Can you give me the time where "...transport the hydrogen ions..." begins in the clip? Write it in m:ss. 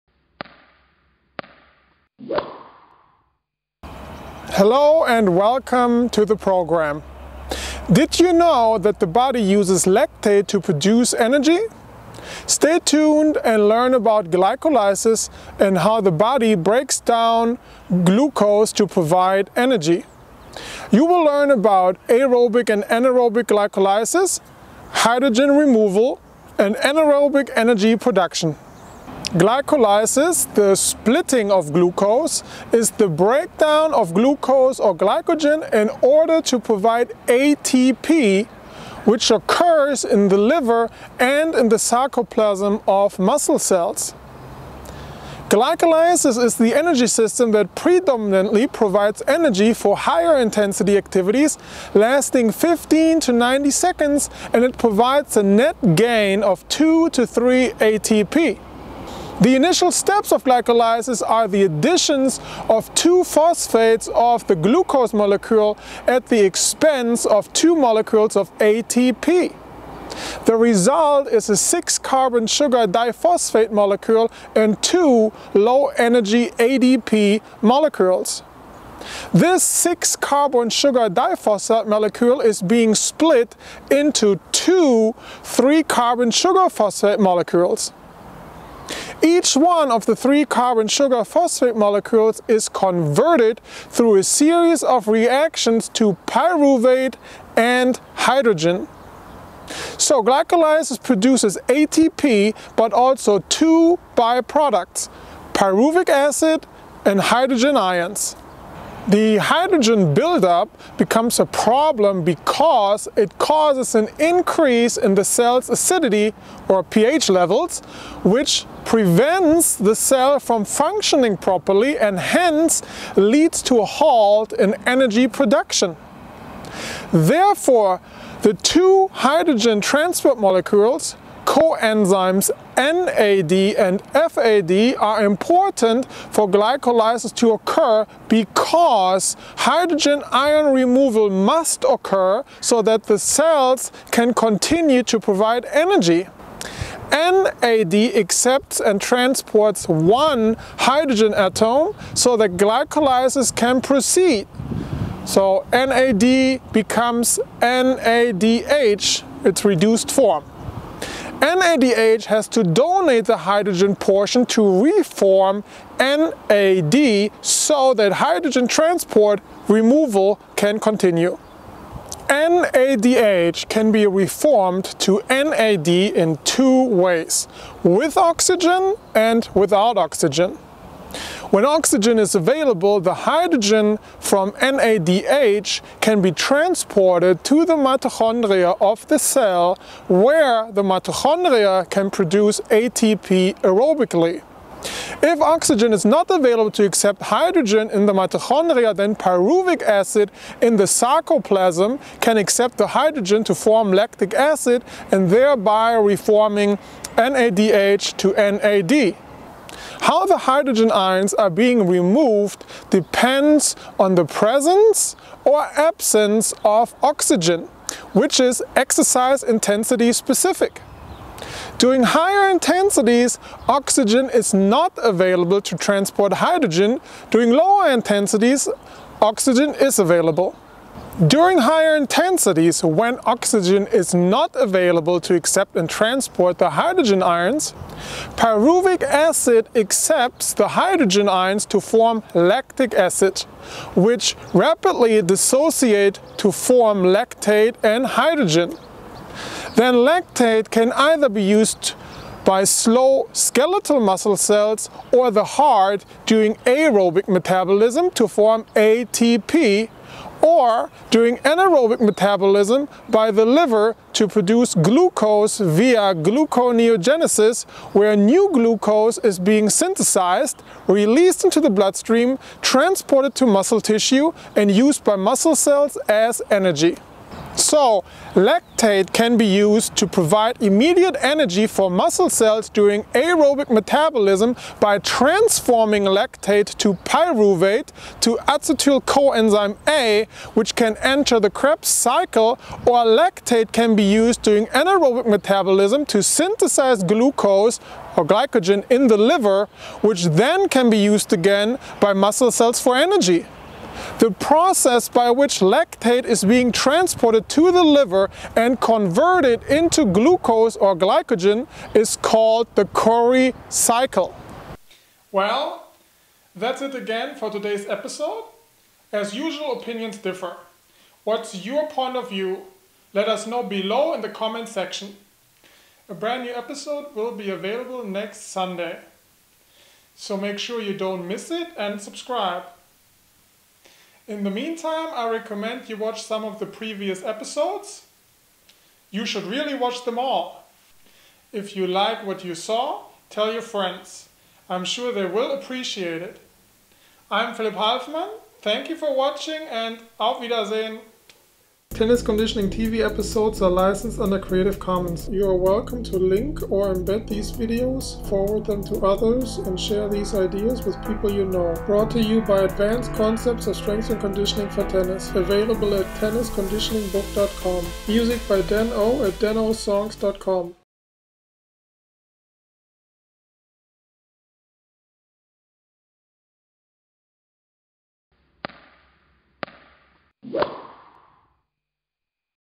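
3:55.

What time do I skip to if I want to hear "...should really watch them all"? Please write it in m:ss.
5:39.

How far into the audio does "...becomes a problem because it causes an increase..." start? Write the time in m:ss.
1:50.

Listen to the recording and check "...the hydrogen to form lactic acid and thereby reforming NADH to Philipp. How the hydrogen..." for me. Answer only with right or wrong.
wrong.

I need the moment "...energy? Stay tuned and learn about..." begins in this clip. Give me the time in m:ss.
0:11.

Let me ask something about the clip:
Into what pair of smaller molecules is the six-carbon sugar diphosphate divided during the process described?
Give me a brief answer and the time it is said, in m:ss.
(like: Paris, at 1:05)
3-carbon sugar phosphate molecules, at 1:25.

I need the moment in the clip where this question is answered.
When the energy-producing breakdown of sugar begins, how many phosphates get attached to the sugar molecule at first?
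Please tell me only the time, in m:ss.
1:02.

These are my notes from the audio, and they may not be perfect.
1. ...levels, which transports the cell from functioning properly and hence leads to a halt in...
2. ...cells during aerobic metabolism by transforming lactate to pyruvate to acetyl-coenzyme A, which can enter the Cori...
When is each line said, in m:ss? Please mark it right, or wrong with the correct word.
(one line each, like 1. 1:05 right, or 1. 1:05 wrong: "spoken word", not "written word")
1. 1:57 wrong: "prevents", not "transports"
2. 4:42 wrong: "Krebs", not "Cori".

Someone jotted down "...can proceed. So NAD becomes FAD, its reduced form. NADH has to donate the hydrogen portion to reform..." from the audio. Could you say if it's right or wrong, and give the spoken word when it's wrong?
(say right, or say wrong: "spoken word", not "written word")
wrong: "NADH", not "FAD".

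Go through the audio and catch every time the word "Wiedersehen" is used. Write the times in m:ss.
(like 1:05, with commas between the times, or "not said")
5:50.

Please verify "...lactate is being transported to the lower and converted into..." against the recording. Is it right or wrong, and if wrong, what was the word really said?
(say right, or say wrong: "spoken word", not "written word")
wrong: "liver", not "lower".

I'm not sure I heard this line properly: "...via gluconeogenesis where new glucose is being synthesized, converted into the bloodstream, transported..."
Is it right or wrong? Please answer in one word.
wrong.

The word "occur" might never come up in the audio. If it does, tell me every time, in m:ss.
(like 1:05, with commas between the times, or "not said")
0:39, 2:17, 2:21.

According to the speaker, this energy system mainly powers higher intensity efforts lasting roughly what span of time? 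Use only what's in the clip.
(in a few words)
15 to 90 seconds.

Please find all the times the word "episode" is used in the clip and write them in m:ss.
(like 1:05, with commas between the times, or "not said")
5:17, 5:26, 5:37, 5:53.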